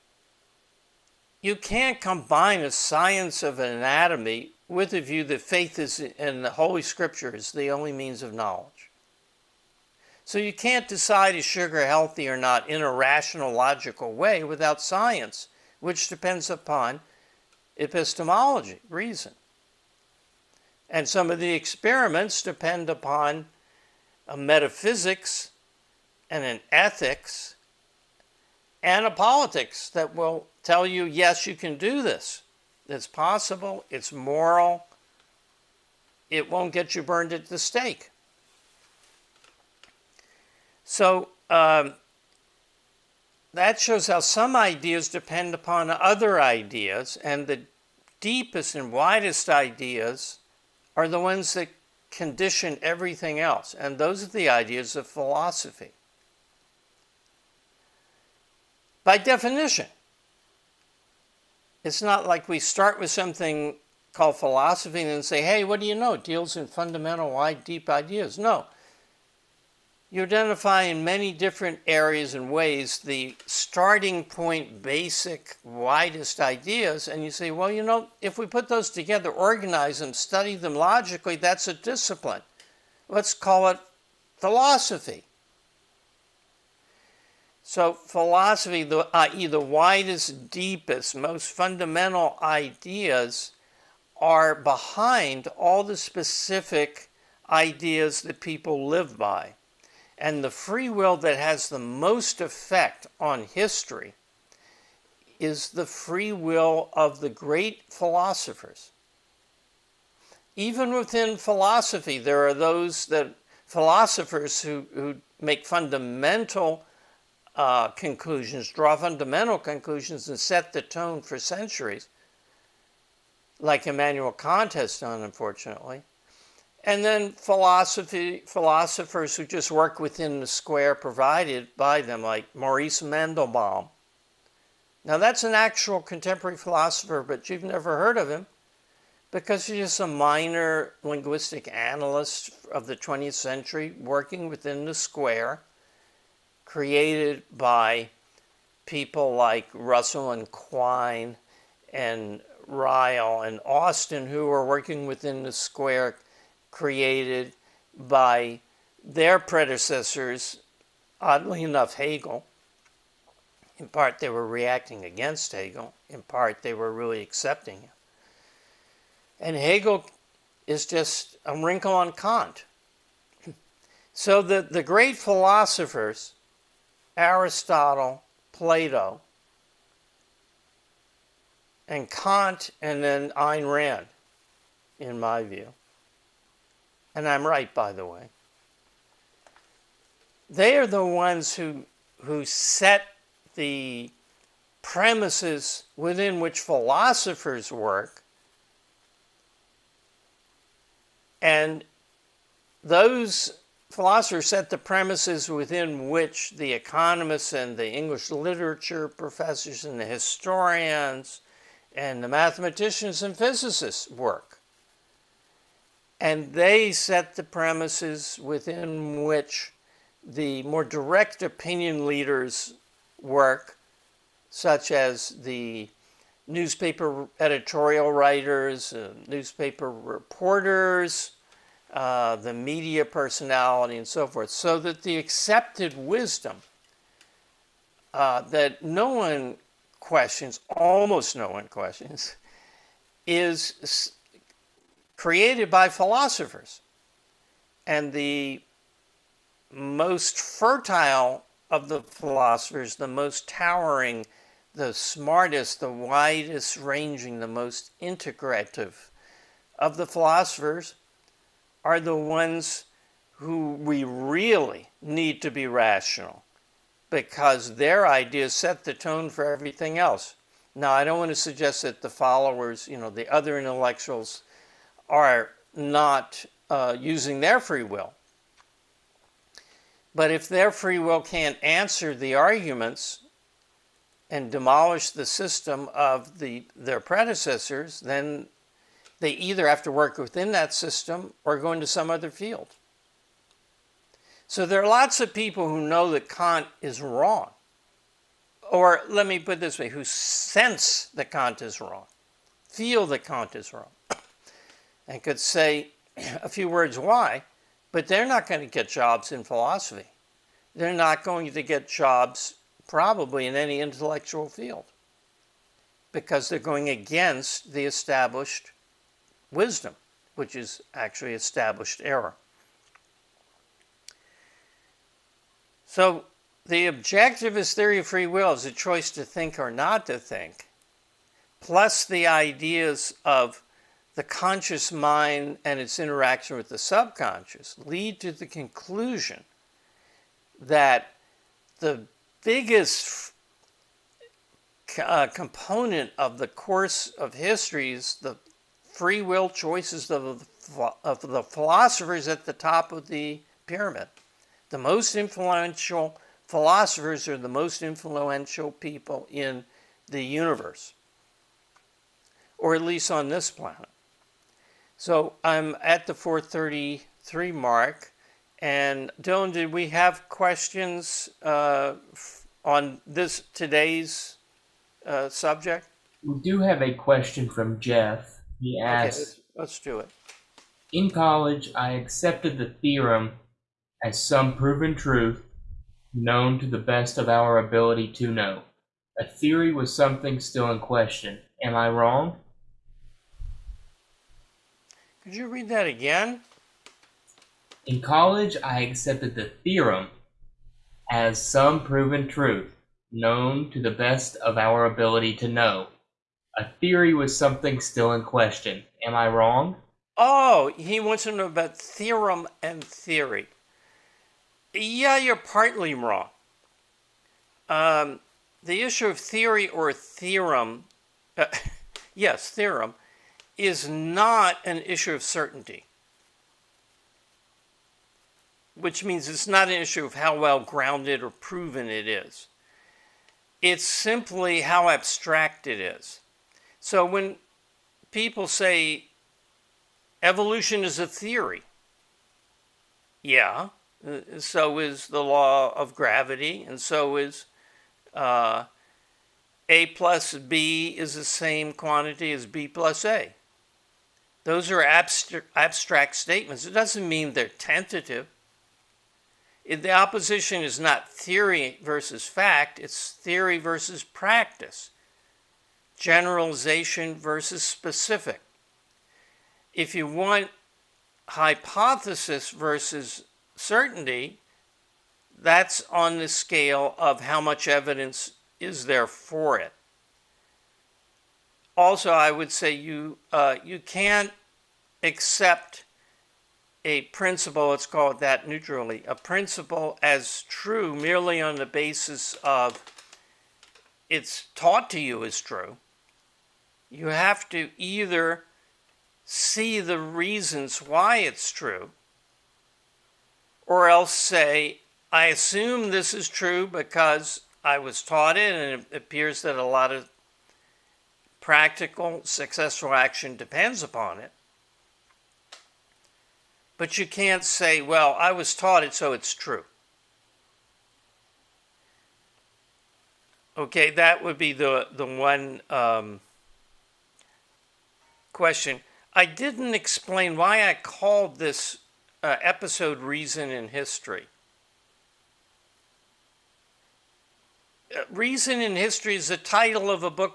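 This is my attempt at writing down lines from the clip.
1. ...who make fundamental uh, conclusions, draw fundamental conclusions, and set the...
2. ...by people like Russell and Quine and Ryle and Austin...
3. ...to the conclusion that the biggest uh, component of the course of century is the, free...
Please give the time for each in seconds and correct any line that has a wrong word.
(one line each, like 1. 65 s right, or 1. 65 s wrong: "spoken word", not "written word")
1. 114 s right
2. 147 s right
3. 338 s wrong: "history", not "century".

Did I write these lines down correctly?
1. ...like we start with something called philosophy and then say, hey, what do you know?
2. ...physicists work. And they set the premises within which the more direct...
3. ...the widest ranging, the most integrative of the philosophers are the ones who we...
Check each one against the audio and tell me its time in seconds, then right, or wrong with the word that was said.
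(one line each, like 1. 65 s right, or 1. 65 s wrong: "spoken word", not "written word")
1. 62 s right
2. 213 s right
3. 255 s right.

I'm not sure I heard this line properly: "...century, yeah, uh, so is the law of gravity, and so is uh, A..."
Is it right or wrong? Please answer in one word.
wrong.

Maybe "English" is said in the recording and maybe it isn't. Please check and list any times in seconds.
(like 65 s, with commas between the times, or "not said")
207 s.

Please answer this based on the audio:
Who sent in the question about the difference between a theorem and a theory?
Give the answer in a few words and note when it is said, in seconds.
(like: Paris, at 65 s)
Jeff, at 377 s.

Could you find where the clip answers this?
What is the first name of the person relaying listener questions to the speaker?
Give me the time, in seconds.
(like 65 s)
369 s.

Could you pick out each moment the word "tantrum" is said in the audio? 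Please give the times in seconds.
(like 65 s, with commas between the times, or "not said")
not said.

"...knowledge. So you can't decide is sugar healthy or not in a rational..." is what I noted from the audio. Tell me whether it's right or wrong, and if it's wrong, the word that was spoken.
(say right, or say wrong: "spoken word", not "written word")
right.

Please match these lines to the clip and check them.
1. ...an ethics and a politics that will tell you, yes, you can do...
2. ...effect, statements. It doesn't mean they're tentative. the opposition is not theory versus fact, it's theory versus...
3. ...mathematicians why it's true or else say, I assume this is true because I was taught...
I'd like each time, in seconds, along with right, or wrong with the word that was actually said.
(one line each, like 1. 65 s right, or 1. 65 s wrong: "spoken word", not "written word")
1. 26 s right
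2. 454 s wrong: "abstract", not "effect"
3. 499 s wrong: "reasons", not "mathematicians".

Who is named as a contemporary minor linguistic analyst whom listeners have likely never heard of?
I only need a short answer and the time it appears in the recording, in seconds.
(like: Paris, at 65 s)
Maurice Mandelbaum, at 132 s.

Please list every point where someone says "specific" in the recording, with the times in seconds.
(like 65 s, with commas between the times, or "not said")
95 s, 467 s.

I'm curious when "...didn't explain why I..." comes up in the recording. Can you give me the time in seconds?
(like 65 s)
529 s.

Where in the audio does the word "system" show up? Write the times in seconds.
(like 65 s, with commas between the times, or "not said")
285 s, 290 s.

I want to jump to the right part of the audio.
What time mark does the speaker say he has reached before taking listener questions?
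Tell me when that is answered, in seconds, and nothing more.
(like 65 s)
366 s.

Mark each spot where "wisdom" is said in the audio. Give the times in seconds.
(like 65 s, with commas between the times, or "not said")
235 s, 319 s.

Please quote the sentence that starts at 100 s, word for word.
And the free will that has the most effect on history is the free will of the great philosophers.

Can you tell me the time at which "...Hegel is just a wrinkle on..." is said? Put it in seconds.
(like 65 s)
169 s.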